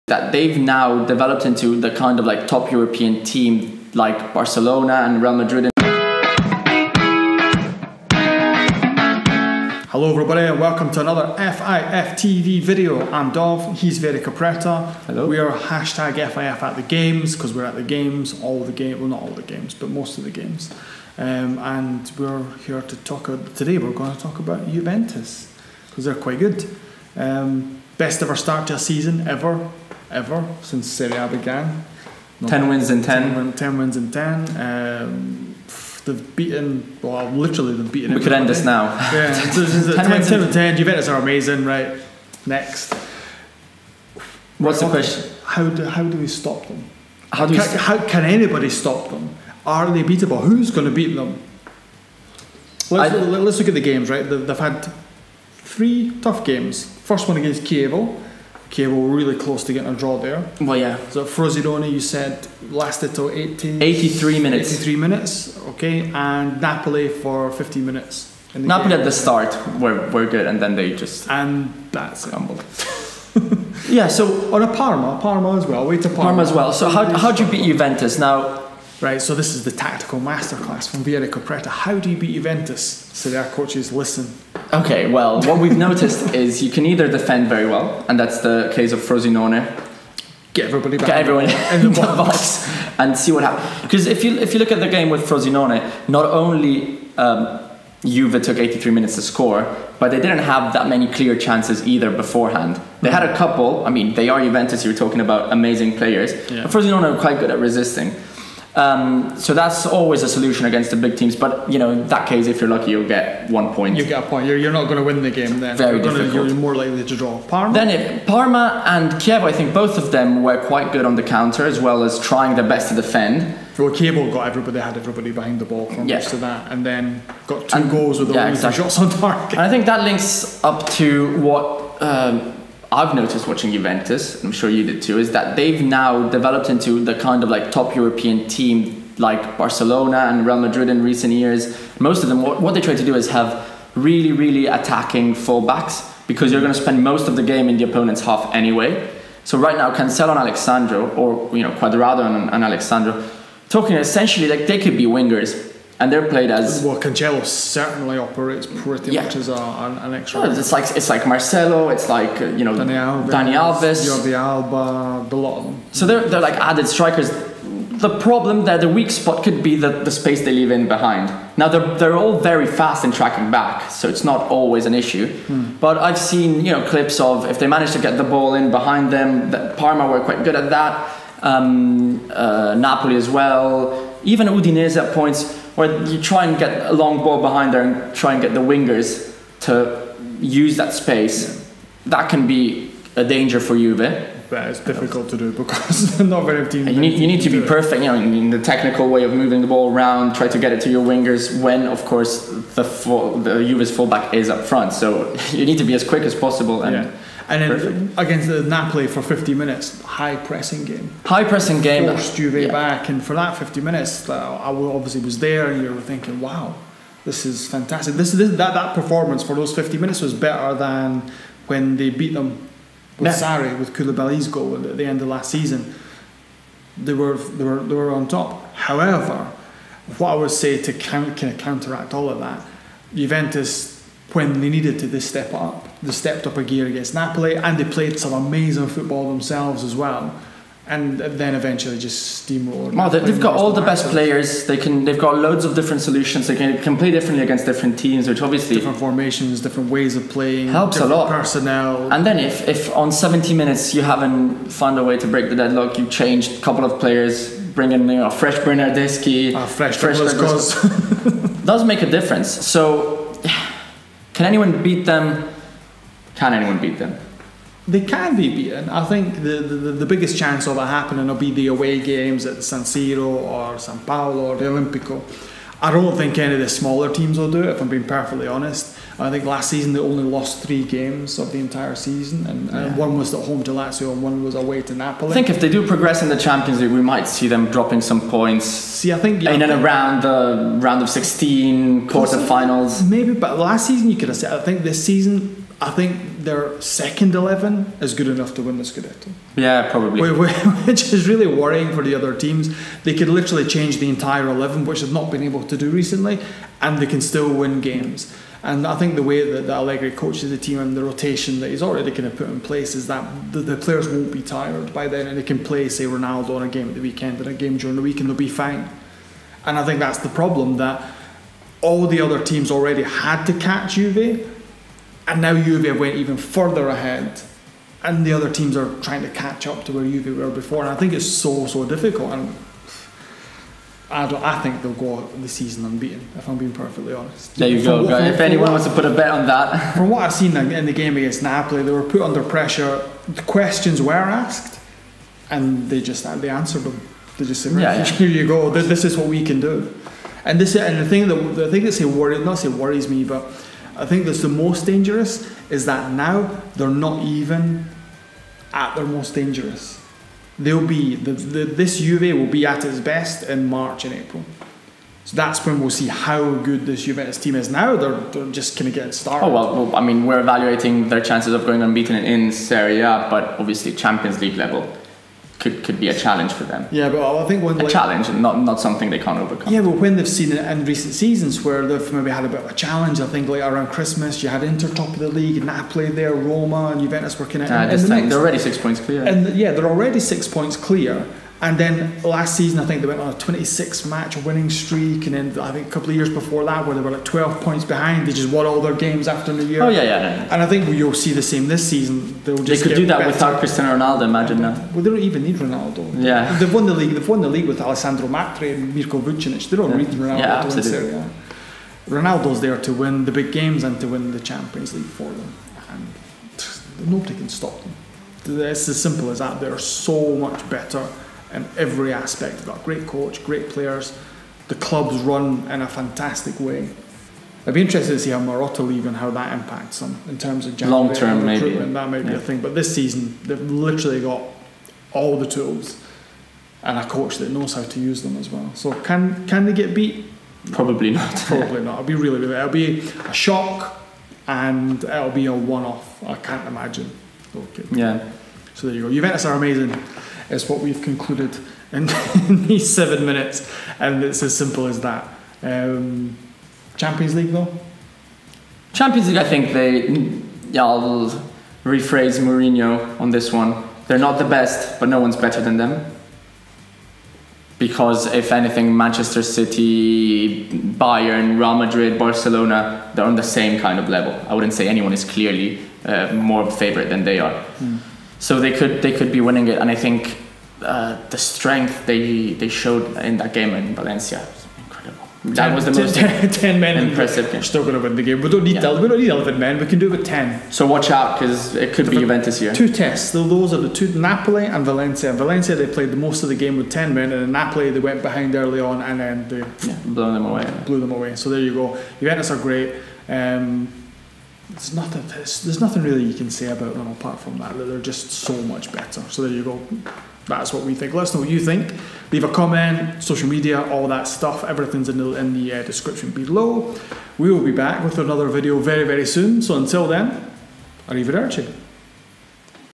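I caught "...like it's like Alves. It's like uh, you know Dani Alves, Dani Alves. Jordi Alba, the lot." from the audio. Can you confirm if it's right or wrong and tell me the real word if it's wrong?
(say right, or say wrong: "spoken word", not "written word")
wrong: "Marcelo", not "Alves".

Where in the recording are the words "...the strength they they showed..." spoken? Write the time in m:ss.
8:01.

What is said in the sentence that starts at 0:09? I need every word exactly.
Hello everybody and welcome to another FIF TV video.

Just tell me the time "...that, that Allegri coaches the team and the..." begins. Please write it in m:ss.
5:09.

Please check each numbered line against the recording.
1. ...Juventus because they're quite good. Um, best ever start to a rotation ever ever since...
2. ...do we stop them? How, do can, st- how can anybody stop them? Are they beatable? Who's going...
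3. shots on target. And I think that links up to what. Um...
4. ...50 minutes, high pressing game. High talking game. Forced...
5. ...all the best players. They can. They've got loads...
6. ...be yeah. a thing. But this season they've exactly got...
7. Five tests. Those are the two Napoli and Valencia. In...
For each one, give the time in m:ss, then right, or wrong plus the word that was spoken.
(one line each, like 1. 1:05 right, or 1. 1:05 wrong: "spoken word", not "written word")
1. 0:24 wrong: "season", not "rotation"
2. 0:46 right
3. 2:08 right
4. 3:29 wrong: "pressing", not "talking"
5. 4:03 right
6. 7:12 wrong: "literally", not "exactly"
7. 8:12 wrong: "Two", not "Five".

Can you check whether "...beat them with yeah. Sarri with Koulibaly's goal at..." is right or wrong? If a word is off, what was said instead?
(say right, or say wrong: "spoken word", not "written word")
right.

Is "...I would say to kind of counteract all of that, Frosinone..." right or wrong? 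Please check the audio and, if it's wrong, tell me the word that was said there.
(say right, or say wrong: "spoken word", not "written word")
wrong: "Juventus", not "Frosinone".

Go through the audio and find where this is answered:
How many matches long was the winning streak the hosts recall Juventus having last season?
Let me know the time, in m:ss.
6:33.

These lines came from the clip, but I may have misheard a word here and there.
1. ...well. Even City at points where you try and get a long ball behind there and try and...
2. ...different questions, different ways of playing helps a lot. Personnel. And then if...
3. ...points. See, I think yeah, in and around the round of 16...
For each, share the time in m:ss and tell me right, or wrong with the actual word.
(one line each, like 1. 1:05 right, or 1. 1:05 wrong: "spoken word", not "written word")
1. 3:03 wrong: "Udinese", not "City"
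2. 4:08 wrong: "formations", not "questions"
3. 4:48 right.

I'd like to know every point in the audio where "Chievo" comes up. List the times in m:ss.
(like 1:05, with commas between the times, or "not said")
0:57, 1:59, 2:03.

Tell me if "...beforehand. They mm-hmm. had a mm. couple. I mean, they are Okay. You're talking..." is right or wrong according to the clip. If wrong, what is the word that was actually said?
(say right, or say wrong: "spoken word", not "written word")
wrong: "Juventus", not "Okay".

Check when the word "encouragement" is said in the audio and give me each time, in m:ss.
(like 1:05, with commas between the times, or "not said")
not said.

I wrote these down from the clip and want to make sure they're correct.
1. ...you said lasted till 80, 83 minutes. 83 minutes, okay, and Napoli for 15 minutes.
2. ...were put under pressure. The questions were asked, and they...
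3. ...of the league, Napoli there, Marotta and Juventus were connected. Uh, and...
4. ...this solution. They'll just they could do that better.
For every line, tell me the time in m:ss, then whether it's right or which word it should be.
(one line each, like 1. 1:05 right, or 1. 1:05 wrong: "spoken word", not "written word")
1. 1:01 right
2. 5:41 right
3. 6:25 wrong: "Roma", not "Marotta"
4. 6:41 wrong: "season", not "solution".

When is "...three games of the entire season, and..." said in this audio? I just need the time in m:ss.
4:40.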